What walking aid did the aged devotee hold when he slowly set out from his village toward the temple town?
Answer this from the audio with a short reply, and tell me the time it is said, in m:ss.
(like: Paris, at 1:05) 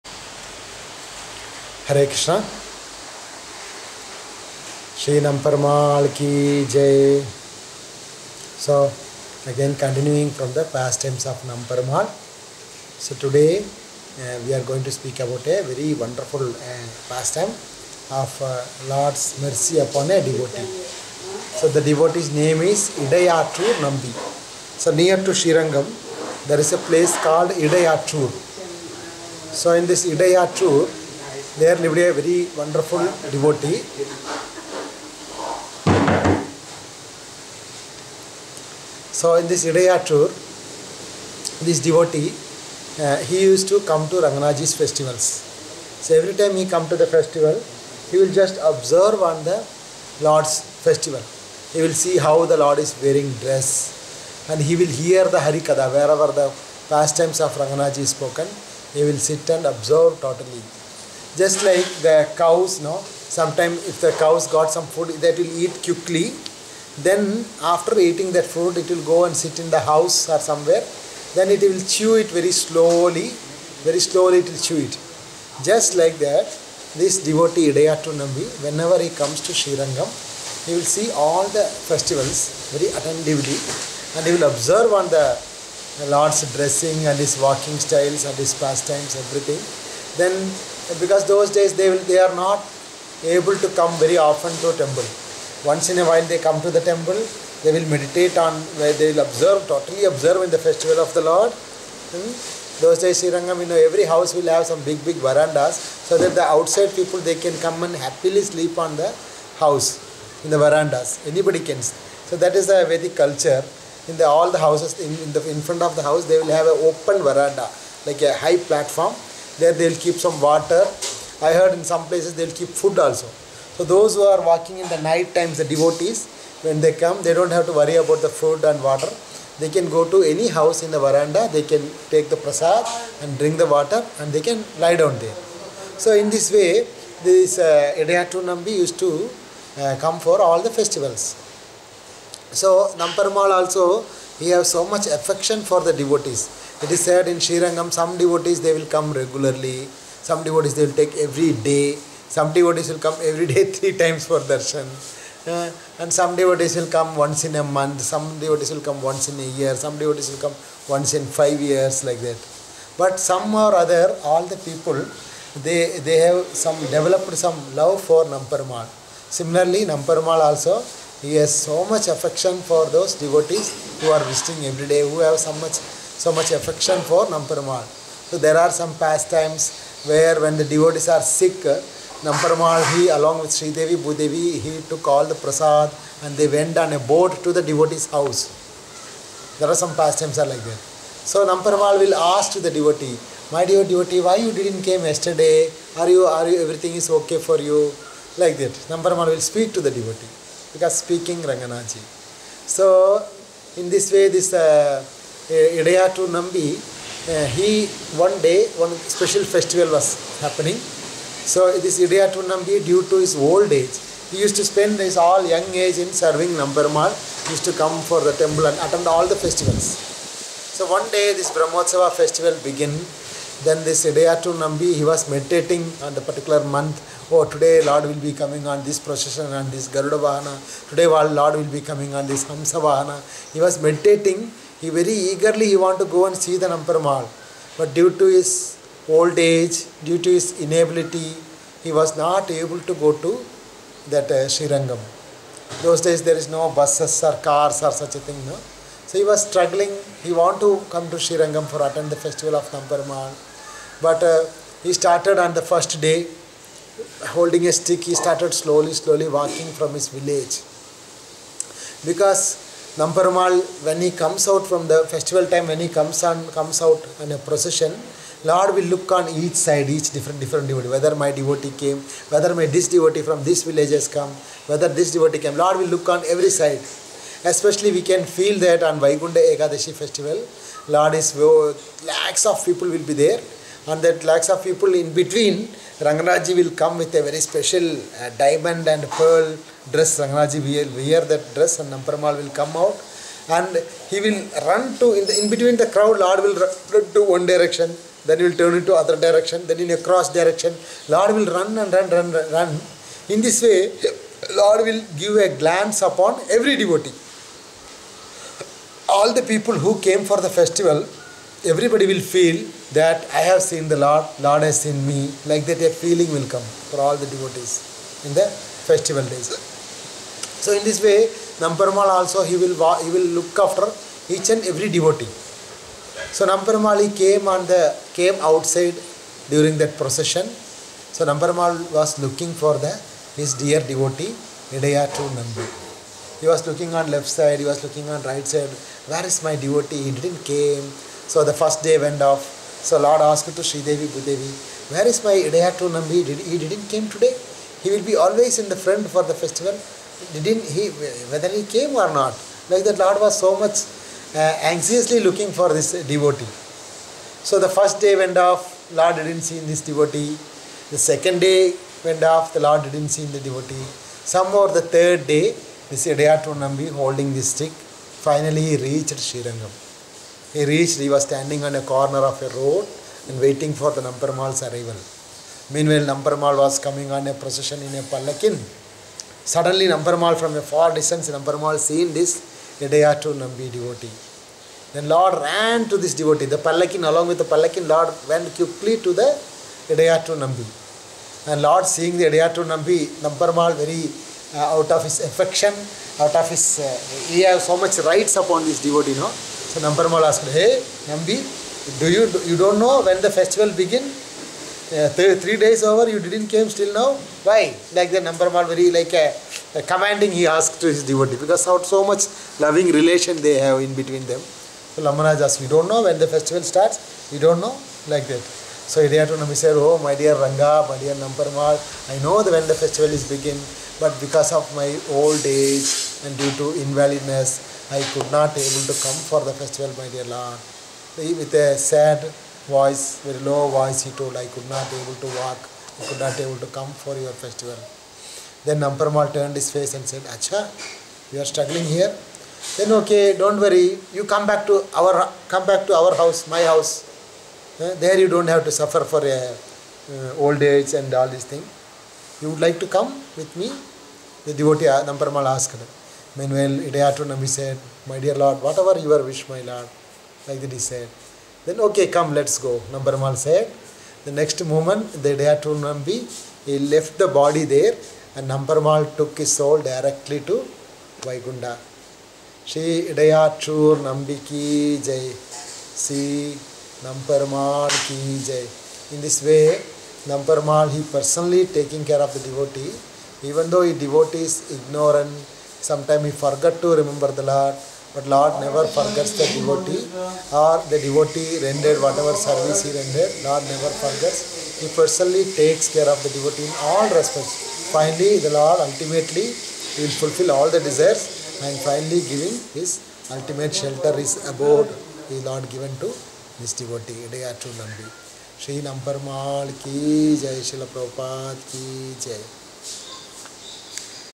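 A stick, at 4:17.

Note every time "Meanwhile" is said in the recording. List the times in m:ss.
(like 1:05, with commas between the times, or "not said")
6:15, 7:36.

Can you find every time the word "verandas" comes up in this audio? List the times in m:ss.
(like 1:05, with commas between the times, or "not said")
1:45, 1:50, 1:57, 2:10.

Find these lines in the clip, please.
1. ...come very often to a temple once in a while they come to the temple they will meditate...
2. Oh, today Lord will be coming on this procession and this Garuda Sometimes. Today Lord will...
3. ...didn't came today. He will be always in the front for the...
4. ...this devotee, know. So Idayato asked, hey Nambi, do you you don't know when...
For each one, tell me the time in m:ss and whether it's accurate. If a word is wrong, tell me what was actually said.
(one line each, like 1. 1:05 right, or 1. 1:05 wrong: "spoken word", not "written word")
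1. 1:33 right
2. 3:47 wrong: "Vahana", not "Sometimes"
3. 5:46 right
4. 6:38 wrong: "Namparmal", not "Idayato".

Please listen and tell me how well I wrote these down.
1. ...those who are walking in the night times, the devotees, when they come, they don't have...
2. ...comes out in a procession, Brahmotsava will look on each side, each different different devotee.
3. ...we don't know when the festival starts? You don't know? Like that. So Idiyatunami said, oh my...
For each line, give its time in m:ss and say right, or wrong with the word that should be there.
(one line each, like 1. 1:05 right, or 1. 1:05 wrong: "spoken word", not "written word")
1. 2:03 right
2. 4:26 wrong: "Lord", not "Brahmotsava"
3. 6:55 right.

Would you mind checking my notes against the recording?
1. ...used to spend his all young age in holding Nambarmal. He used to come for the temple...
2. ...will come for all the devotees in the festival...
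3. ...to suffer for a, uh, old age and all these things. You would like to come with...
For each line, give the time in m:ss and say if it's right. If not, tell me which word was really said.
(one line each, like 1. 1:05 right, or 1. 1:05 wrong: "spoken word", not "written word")
1. 3:34 wrong: "serving", not "holding"
2. 5:16 right
3. 7:28 right.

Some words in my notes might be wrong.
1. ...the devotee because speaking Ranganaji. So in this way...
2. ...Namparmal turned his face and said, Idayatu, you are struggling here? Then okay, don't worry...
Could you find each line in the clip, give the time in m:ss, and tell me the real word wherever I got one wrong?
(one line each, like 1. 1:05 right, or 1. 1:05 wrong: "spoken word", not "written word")
1. 3:19 right
2. 7:18 wrong: "Acha", not "Idayatu".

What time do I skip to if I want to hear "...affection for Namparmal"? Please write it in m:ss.
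2:56.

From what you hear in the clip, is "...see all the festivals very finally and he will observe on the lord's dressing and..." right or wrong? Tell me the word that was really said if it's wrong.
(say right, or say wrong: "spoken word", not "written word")
wrong: "attentively", not "finally".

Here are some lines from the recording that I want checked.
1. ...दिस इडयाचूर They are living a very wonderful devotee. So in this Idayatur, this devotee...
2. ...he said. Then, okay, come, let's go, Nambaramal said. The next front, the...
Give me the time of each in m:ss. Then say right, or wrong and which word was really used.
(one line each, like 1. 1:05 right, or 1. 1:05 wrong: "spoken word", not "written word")
1. 0:29 right
2. 7:40 wrong: "moment", not "front".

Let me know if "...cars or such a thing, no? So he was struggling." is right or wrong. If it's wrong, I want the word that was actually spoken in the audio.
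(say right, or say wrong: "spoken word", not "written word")
right.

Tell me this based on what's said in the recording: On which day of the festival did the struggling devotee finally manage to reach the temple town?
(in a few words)
Third day.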